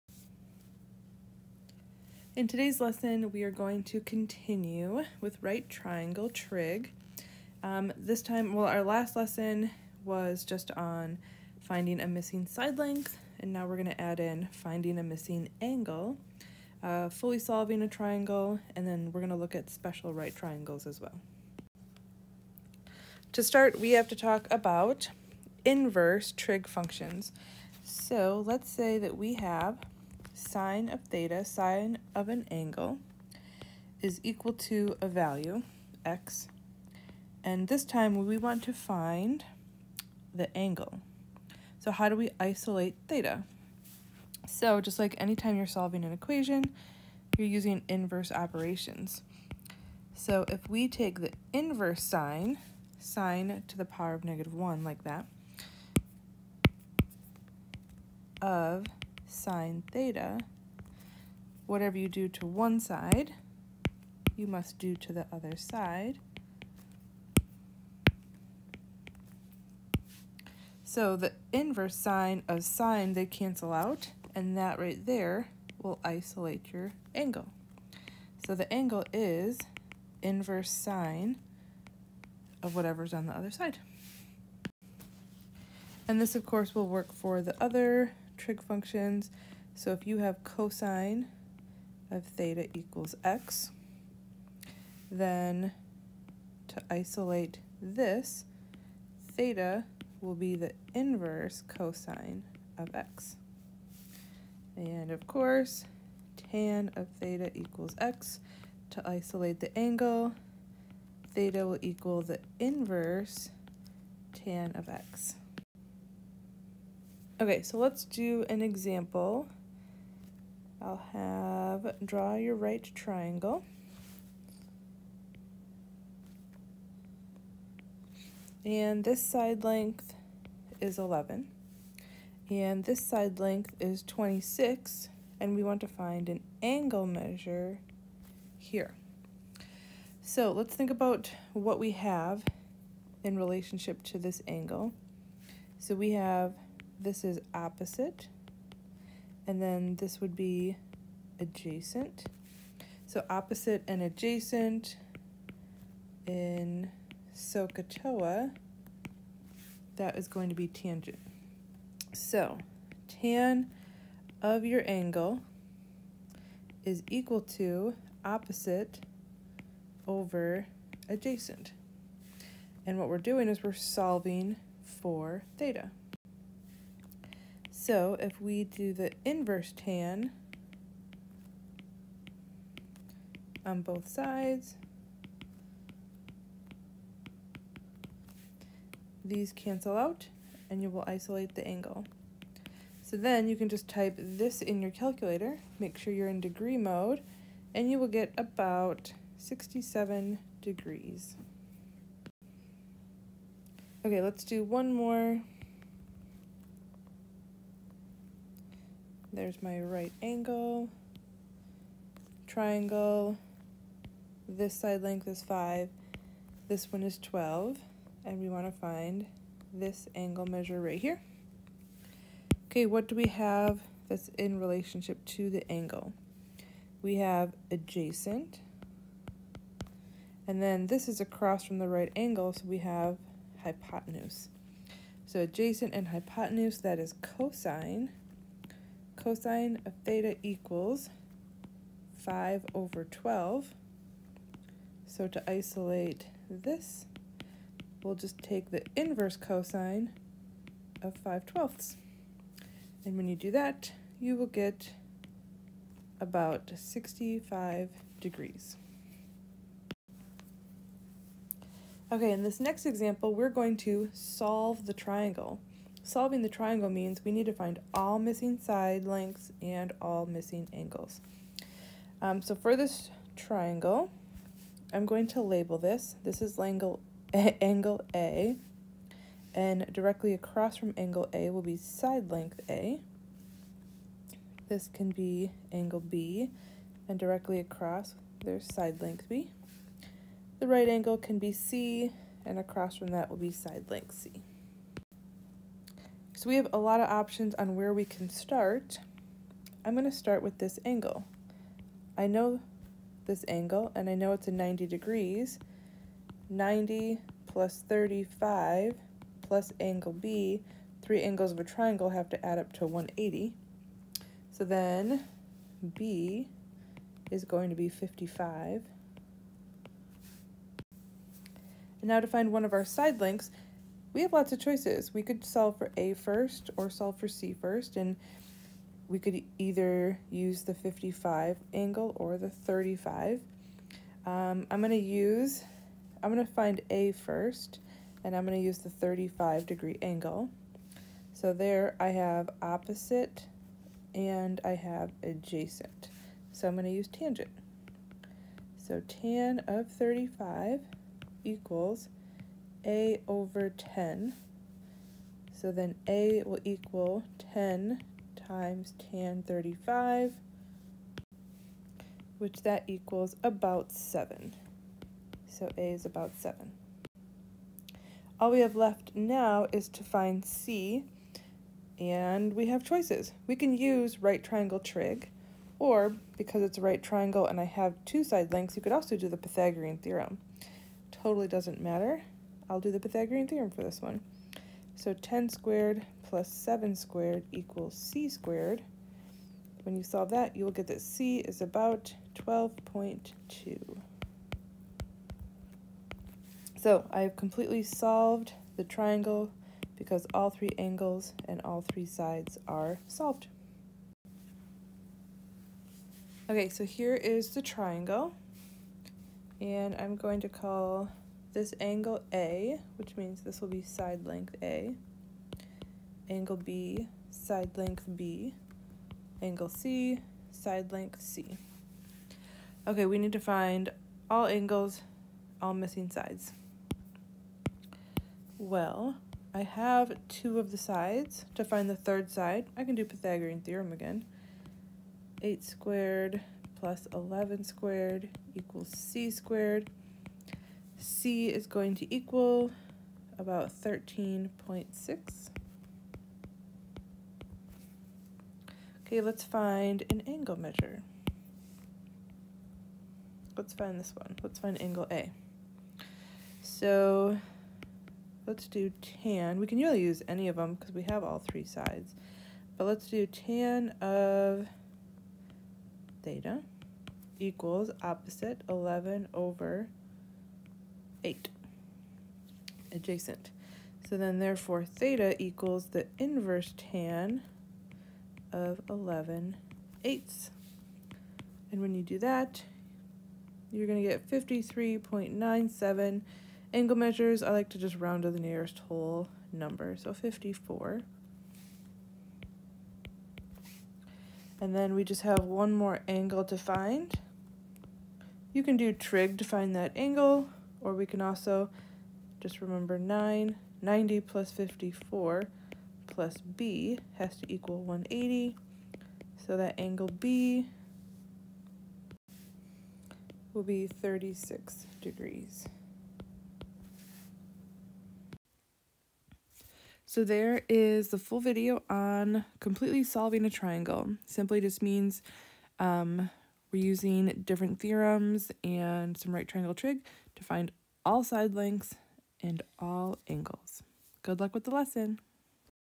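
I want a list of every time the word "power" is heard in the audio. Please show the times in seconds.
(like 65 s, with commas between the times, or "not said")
53 s.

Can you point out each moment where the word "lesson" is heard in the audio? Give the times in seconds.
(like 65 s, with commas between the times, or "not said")
2 s, 9 s, 534 s.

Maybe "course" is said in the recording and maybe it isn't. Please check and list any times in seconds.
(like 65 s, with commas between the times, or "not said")
86 s, 105 s.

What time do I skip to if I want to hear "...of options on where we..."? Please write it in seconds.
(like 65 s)
296 s.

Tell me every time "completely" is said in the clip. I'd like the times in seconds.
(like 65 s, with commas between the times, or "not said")
397 s, 522 s.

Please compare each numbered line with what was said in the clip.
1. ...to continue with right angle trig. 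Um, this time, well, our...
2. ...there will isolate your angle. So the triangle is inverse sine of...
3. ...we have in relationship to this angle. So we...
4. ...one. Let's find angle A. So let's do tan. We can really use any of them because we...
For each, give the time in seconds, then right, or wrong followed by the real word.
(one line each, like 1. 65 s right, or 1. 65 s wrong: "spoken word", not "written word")
1. 3 s wrong: "triangle", not "angle"
2. 75 s wrong: "angle", not "triangle"
3. 141 s right
4. 454 s right.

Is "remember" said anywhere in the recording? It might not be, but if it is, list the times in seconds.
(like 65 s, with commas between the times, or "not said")
502 s.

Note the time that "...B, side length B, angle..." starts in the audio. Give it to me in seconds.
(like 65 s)
416 s.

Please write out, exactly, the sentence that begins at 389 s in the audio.
When you solve that, you will get that c is about 12.2.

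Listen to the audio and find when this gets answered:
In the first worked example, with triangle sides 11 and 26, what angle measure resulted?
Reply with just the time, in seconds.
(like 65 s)
198 s.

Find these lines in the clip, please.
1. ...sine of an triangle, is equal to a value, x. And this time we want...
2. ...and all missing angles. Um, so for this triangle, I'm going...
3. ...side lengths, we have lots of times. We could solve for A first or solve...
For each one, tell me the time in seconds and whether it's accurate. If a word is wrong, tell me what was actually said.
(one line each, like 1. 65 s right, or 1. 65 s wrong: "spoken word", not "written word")
1. 31 s wrong: "angle", not "triangle"
2. 269 s right
3. 322 s wrong: "choices", not "times".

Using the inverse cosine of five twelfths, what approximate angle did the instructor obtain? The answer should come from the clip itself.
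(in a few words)
65 degrees.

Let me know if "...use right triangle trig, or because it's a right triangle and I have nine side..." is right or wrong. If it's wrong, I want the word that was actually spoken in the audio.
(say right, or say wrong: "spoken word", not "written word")
wrong: "two", not "nine".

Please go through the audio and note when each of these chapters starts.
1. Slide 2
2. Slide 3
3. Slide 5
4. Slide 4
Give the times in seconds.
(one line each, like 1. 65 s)
1. 116 s
2. 202 s
3. 404 s
4. 260 s.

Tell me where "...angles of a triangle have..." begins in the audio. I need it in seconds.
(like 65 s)
311 s.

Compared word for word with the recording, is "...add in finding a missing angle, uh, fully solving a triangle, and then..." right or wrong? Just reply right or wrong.
right.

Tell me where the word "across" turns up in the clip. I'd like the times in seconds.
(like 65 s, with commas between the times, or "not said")
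231 s, 280 s, 287 s, 292 s.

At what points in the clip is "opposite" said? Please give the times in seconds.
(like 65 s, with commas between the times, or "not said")
147 s, 153 s, 168 s, 342 s, 468 s.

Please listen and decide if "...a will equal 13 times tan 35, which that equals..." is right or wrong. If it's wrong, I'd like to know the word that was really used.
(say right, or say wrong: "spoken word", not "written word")
wrong: "10", not "13".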